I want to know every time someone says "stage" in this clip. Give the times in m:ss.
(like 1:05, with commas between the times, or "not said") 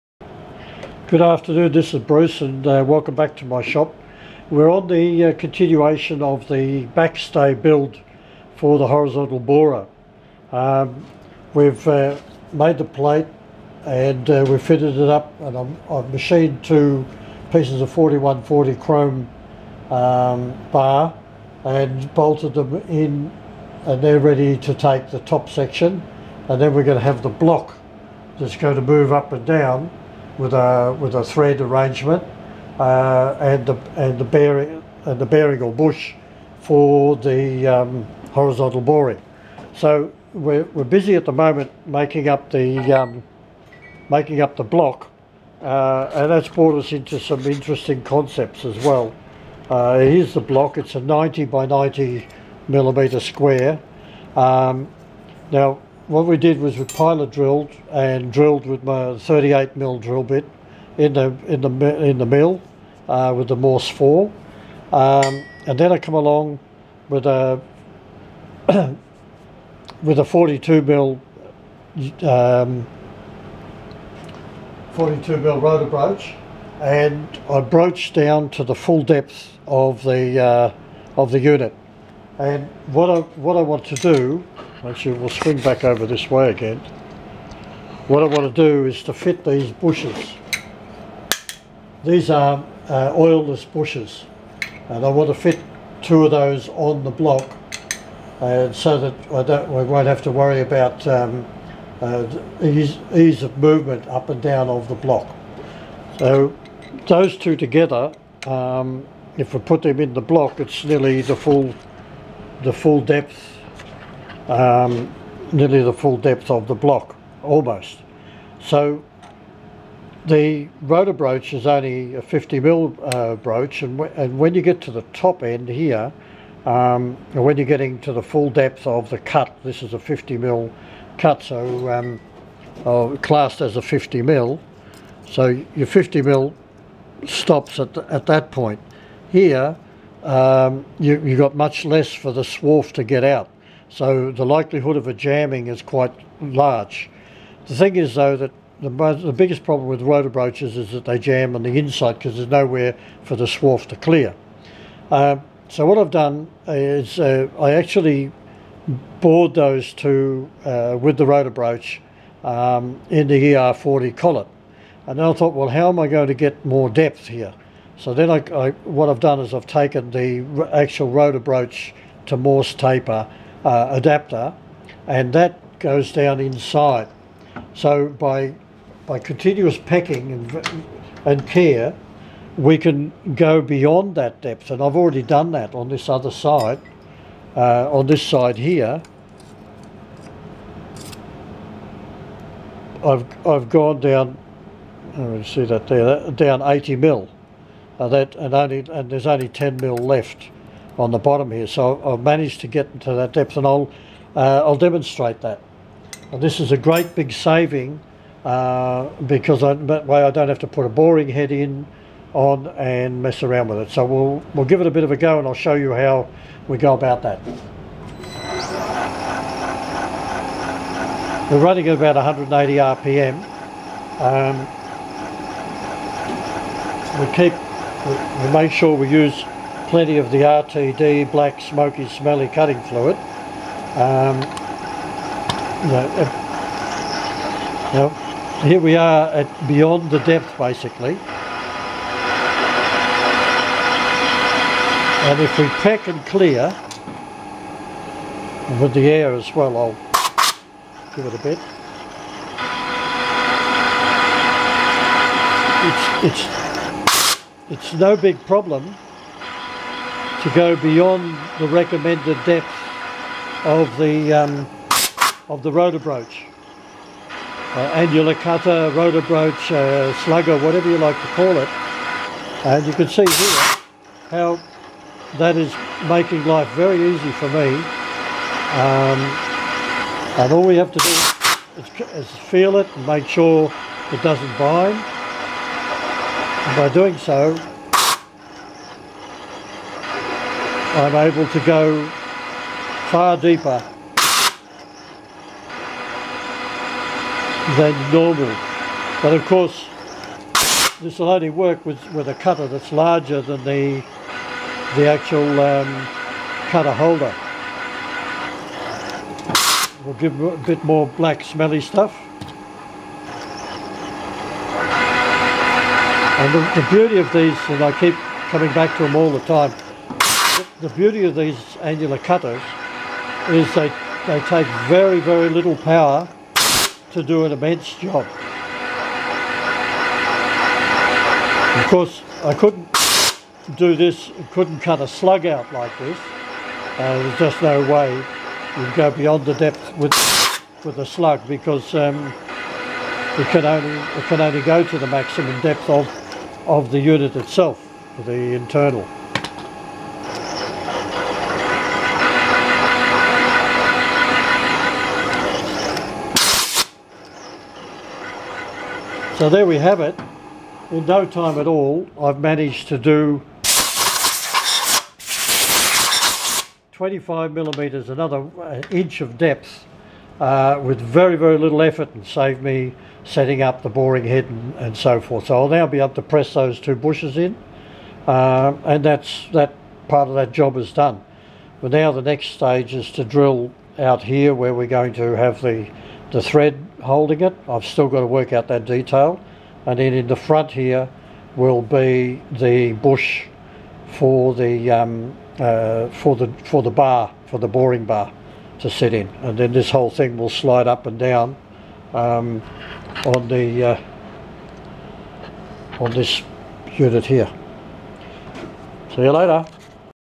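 6:22.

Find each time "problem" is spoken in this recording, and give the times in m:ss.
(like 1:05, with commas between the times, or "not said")
2:29, 4:18.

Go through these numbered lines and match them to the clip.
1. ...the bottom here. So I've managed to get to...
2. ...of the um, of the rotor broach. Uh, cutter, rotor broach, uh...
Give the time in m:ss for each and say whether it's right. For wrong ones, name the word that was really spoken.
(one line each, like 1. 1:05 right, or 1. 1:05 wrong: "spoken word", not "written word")
1. 3:21 right
2. 4:23 right.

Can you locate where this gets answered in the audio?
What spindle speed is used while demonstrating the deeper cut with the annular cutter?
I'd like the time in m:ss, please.
3:42.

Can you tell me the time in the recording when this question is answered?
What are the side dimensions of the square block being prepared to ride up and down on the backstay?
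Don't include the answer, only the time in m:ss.
0:50.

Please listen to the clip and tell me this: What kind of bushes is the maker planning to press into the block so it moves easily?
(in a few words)
Oilless bushes.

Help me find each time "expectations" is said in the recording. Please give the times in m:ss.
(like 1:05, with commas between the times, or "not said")
not said.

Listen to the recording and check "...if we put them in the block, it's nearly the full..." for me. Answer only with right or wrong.
right.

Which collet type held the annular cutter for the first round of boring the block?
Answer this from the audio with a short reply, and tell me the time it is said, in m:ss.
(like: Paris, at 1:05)
ER40, at 2:43.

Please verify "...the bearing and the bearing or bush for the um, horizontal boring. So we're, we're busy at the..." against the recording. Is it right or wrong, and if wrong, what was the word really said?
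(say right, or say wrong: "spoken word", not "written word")
right.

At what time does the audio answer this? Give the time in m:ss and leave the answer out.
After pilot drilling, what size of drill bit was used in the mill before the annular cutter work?
0:59.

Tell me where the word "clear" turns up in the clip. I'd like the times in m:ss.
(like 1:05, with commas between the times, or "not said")
2:33, 4:06.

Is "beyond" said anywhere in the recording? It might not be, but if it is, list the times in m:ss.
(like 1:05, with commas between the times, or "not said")
3:03, 3:59, 4:20, 5:39.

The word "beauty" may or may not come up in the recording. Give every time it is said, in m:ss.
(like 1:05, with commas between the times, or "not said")
5:16, 5:20.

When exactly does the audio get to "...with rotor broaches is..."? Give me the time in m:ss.
2:29.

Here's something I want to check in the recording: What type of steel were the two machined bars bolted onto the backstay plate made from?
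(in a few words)
4140 chrome.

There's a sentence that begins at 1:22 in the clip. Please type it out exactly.
And what I what I want to do Actually, we'll swing back over this way again.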